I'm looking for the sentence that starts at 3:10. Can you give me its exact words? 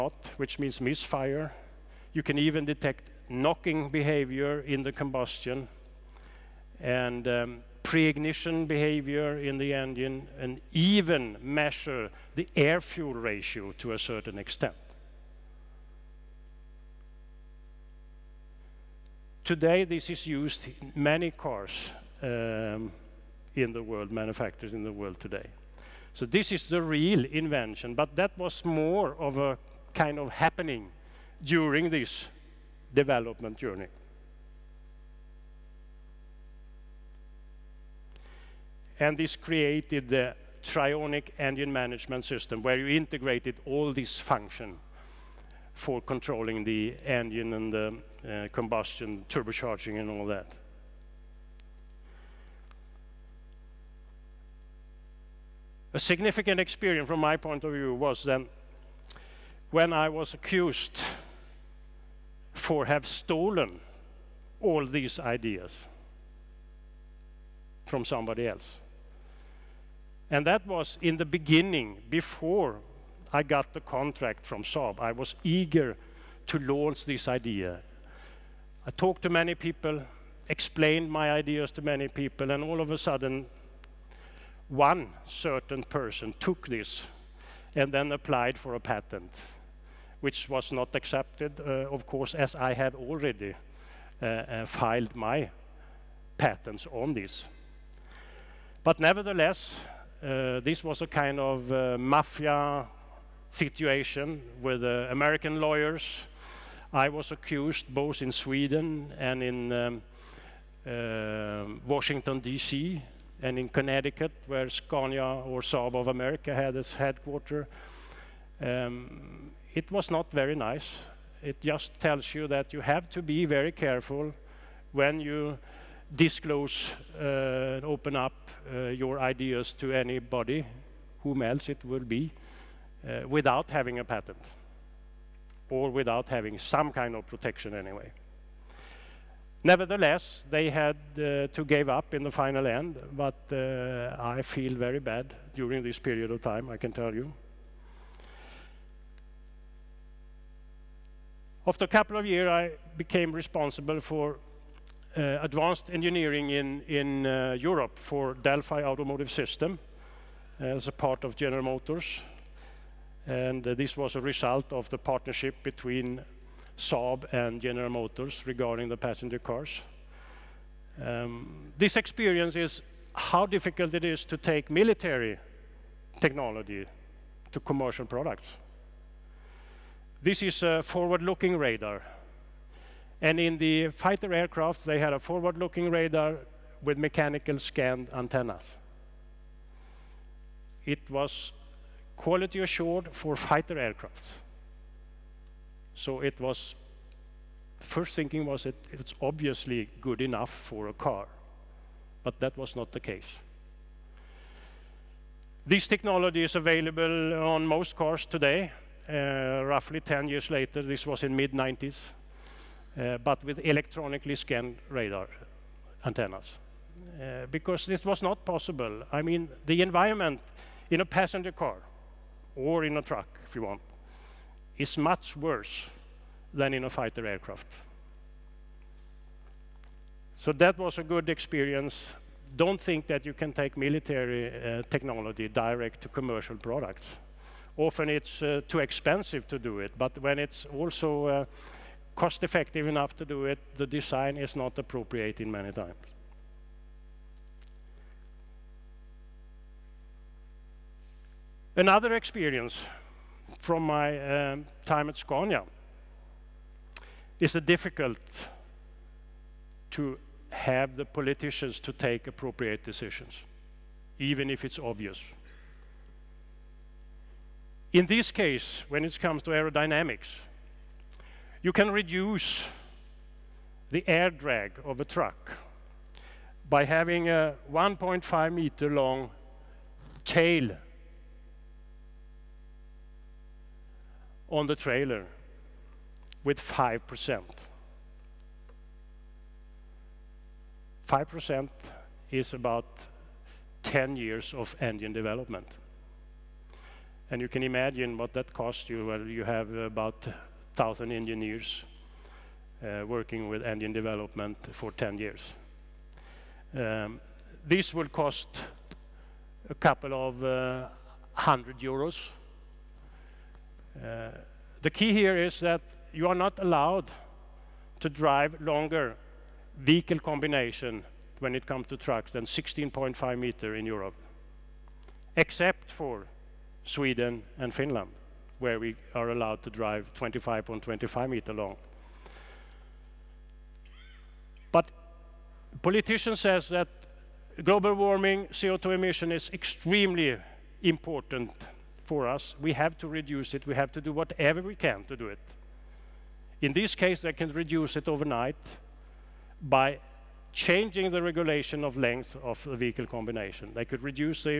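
It was quality assured for fighter aircraft.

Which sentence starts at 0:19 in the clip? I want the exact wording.
Today, this is used in many cars um, in the world, manufacturers in the world today.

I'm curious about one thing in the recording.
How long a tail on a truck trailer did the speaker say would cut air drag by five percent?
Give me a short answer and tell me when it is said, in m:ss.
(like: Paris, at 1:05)
1.5 meters, at 4:37.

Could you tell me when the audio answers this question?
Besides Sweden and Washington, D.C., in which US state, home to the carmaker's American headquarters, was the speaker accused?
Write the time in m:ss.
1:53.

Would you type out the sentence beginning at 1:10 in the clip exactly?
And that was in the beginning, before I got the contract from Saab.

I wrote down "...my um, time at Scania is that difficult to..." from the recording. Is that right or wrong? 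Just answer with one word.
right.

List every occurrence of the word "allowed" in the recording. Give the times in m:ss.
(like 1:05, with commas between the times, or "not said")
5:16, 5:29.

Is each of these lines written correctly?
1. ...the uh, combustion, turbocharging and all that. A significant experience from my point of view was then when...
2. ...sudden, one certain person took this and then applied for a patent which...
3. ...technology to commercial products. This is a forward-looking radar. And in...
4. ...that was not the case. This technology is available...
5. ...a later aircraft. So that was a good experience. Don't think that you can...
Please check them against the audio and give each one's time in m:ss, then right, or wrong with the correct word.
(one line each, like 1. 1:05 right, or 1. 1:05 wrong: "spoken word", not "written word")
1. 0:47 right
2. 1:22 right
3. 2:56 right
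4. 3:22 right
5. 3:46 wrong: "fighter", not "later".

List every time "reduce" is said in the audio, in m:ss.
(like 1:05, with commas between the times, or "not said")
4:31, 5:43, 5:47, 5:54.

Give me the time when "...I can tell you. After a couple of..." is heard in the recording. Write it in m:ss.
2:26.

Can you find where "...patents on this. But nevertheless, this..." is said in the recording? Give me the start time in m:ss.
1:36.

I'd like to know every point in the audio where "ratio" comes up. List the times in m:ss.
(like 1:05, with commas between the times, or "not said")
0:13.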